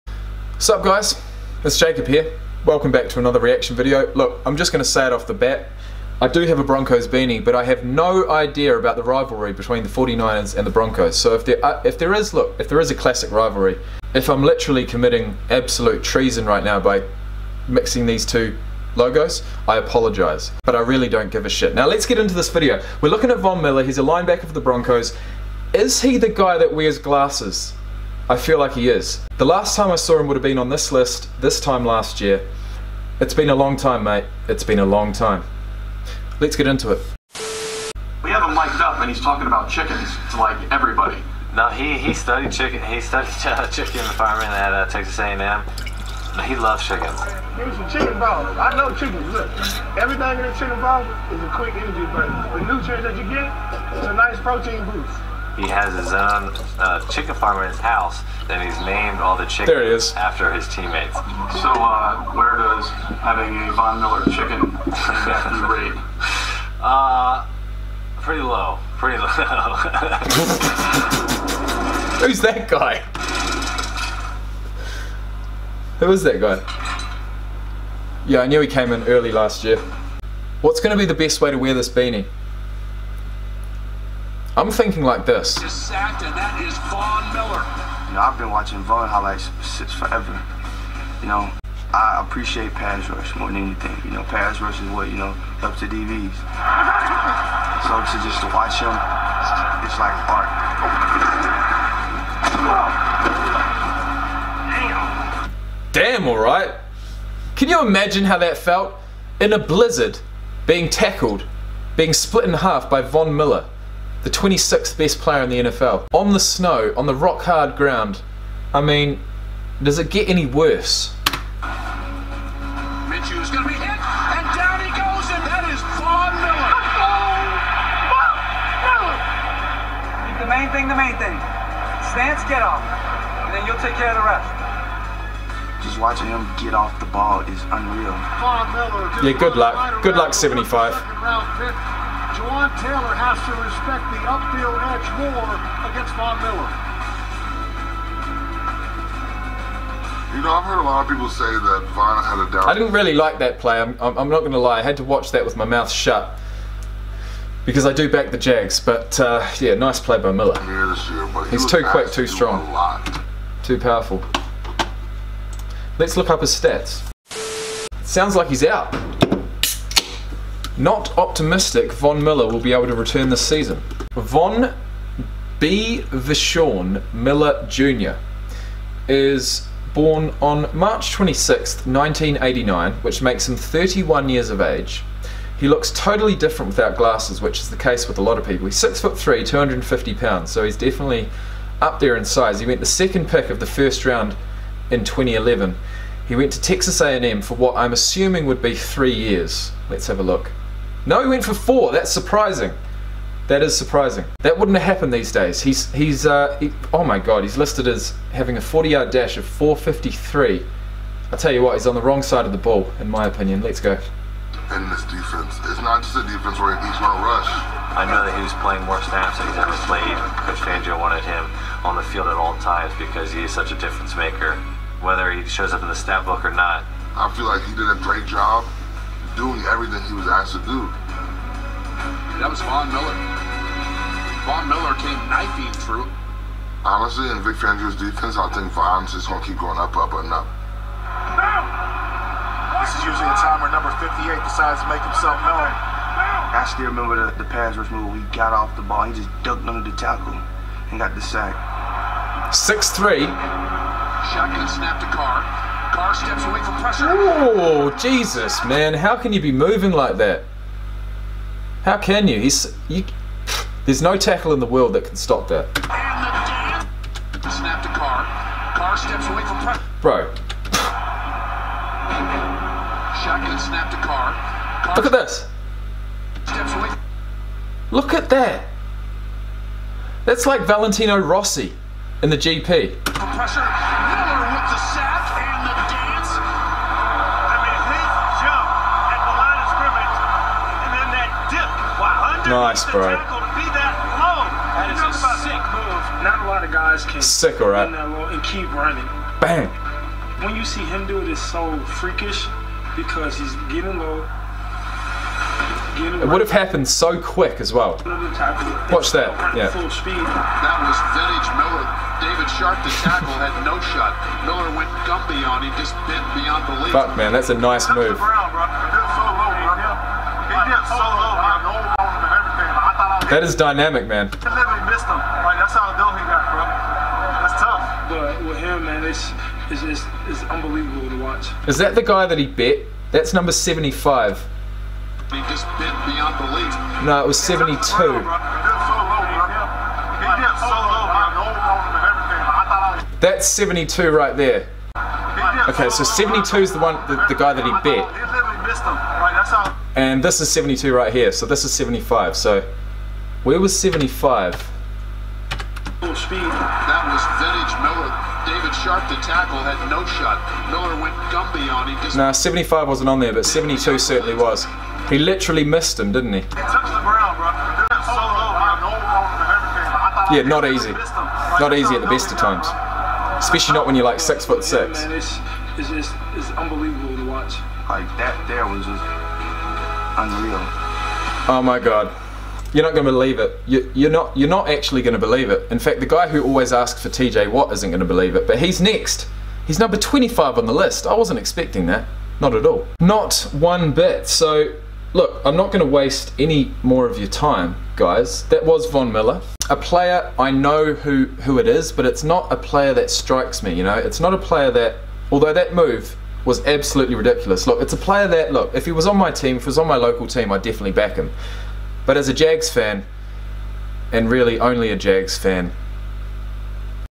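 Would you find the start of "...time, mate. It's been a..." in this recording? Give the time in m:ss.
0:33.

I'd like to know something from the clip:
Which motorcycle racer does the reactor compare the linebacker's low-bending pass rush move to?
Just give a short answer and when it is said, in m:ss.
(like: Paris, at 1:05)
Valentino Rossi, at 4:40.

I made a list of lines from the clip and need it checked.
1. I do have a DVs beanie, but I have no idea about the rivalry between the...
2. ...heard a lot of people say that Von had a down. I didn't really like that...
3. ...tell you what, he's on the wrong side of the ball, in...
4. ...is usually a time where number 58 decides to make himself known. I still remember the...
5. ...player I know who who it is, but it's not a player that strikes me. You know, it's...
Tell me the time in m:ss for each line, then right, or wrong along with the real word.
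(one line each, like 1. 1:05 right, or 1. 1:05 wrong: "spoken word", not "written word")
1. 0:06 wrong: "Broncos", not "DVs"
2. 2:30 right
3. 3:31 right
4. 4:02 right
5. 6:39 right.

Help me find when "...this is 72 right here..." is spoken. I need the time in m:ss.
5:50.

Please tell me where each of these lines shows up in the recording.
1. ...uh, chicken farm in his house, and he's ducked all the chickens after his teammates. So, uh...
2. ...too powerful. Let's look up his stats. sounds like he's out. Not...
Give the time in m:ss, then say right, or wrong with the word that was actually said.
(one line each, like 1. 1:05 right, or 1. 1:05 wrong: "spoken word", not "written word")
1. 0:56 wrong: "named", not "ducked"
2. 2:43 right.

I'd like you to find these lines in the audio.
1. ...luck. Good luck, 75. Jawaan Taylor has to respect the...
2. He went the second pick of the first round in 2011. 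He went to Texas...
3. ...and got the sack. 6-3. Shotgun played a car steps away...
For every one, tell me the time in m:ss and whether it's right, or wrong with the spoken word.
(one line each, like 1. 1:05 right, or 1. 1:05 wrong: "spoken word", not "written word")
1. 2:19 right
2. 3:12 right
3. 4:10 wrong: "snapped", not "played".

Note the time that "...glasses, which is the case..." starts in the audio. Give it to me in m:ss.
3:06.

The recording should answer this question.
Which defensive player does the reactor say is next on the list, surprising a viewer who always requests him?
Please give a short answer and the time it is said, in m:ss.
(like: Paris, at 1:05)
TJ Watt, at 6:27.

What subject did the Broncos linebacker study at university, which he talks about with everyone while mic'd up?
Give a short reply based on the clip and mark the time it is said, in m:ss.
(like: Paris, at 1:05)
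Chicken farming, at 0:43.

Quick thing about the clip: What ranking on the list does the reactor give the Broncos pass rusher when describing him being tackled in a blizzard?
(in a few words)
26th.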